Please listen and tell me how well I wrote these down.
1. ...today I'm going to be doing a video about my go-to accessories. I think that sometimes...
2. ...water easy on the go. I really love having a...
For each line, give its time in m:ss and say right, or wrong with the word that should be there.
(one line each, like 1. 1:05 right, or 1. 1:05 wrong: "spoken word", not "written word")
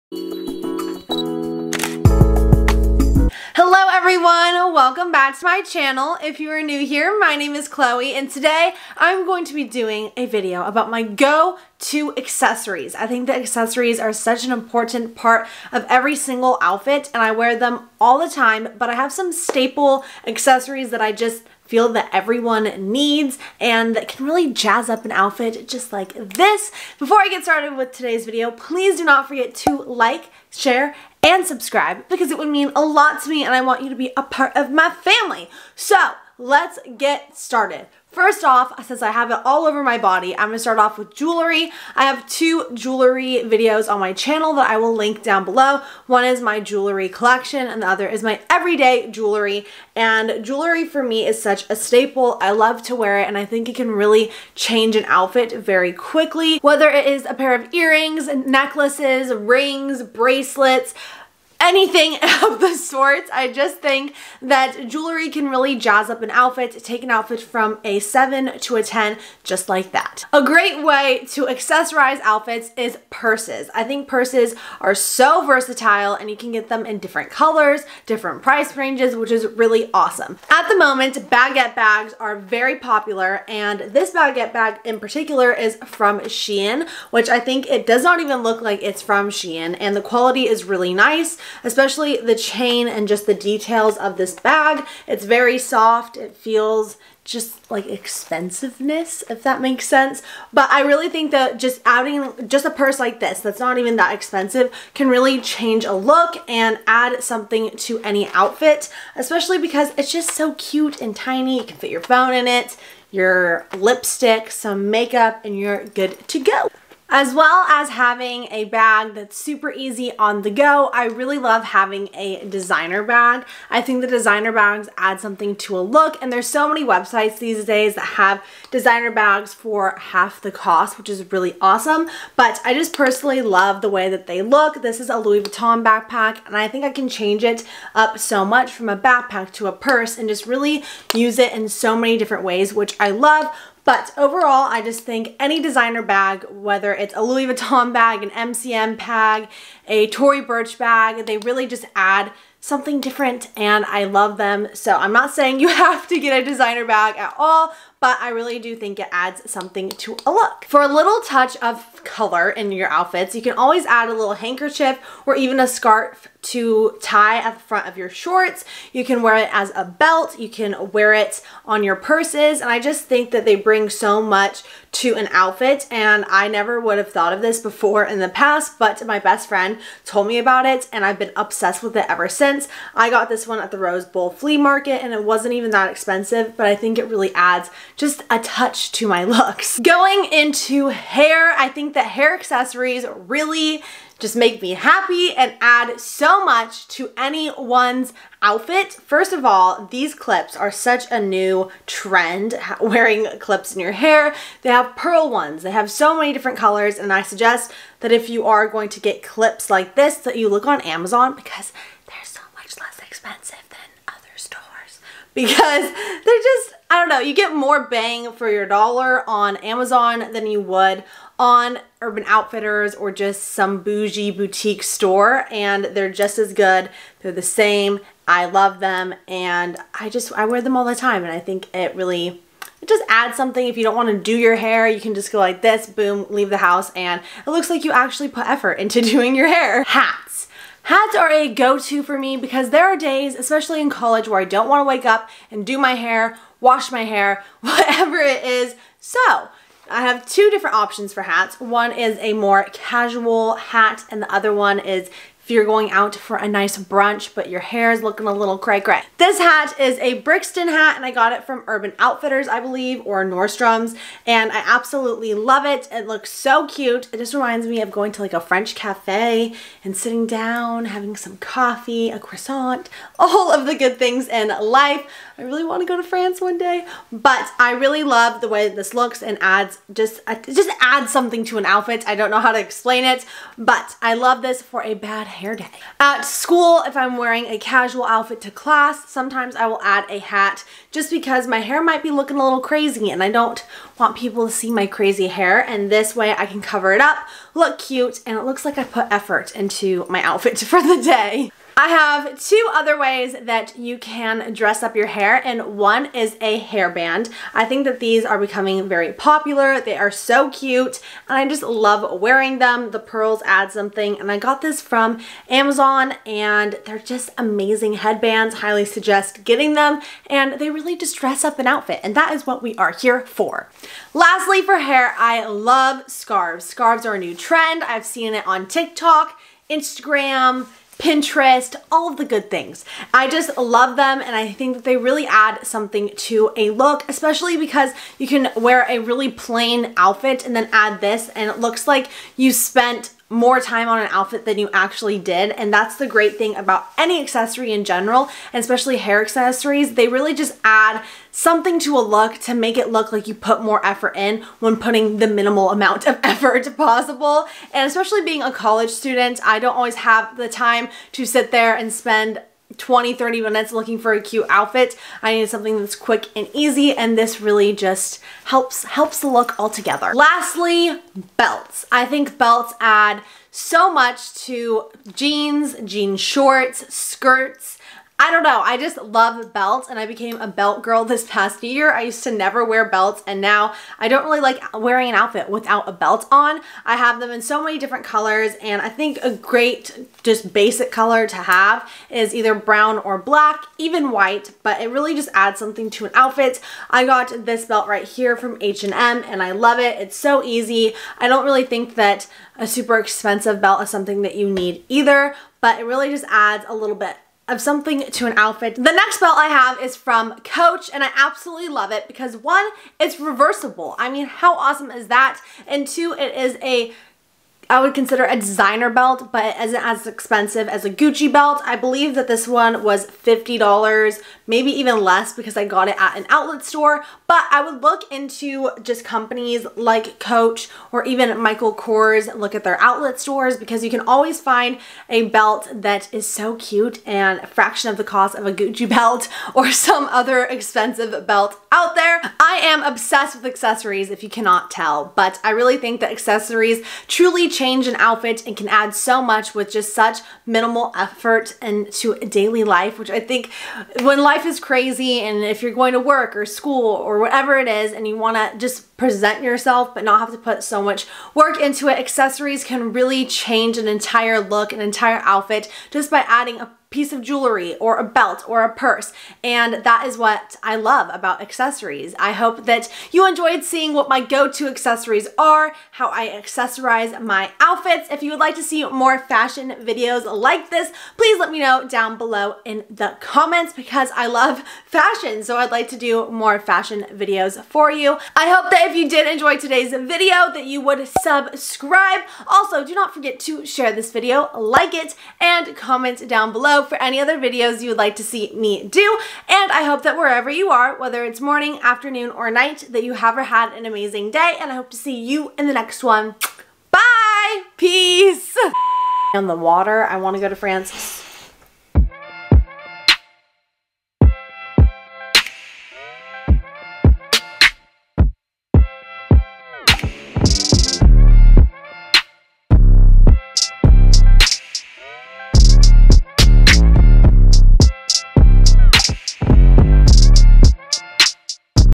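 1. 0:08 wrong: "accessories", not "sometimes"
2. 1:59 wrong: "super", not "water".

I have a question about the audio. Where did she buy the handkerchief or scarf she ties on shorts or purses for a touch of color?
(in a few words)
Rose Bowl flea market.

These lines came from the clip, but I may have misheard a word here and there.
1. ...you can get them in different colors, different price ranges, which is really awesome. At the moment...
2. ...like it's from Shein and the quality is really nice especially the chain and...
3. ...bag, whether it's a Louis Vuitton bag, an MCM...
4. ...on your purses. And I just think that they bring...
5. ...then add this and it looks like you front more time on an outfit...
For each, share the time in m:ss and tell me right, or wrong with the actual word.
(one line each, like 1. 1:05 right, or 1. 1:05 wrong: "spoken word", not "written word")
1. 1:16 right
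2. 1:28 right
3. 2:26 right
4. 2:51 right
5. 5:40 wrong: "spent", not "front".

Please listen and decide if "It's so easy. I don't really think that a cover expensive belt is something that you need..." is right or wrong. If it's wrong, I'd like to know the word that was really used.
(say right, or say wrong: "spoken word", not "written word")
wrong: "super", not "cover".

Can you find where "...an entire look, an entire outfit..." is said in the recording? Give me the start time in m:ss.
7:43.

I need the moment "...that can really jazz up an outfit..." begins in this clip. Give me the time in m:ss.
0:23.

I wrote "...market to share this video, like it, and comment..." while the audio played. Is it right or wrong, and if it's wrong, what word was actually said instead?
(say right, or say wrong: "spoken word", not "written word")
wrong: "forget", not "market".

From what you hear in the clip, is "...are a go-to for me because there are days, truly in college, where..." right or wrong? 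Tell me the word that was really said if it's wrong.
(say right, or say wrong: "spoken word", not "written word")
wrong: "especially", not "truly".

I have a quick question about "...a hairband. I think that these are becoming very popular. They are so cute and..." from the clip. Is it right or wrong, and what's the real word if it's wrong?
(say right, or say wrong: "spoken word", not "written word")
right.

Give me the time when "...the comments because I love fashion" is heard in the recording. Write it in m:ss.
8:02.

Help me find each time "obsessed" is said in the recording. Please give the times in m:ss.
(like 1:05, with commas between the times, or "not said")
3:01, 7:22.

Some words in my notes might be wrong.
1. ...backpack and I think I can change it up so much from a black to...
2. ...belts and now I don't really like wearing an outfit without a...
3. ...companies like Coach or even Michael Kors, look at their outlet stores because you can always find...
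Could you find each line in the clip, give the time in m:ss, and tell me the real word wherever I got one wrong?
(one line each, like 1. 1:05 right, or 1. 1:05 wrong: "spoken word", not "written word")
1. 2:15 wrong: "backpack", not "black"
2. 6:22 right
3. 7:09 right.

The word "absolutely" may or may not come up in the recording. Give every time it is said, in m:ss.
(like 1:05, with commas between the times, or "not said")
4:24, 6:51.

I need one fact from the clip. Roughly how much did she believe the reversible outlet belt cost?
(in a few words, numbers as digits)
$50.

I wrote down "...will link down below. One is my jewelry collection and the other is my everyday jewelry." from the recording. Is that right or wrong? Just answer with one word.
right.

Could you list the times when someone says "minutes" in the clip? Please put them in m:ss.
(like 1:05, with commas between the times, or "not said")
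6:03.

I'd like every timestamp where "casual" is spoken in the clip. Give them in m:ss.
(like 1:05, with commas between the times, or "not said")
4:12, 4:47.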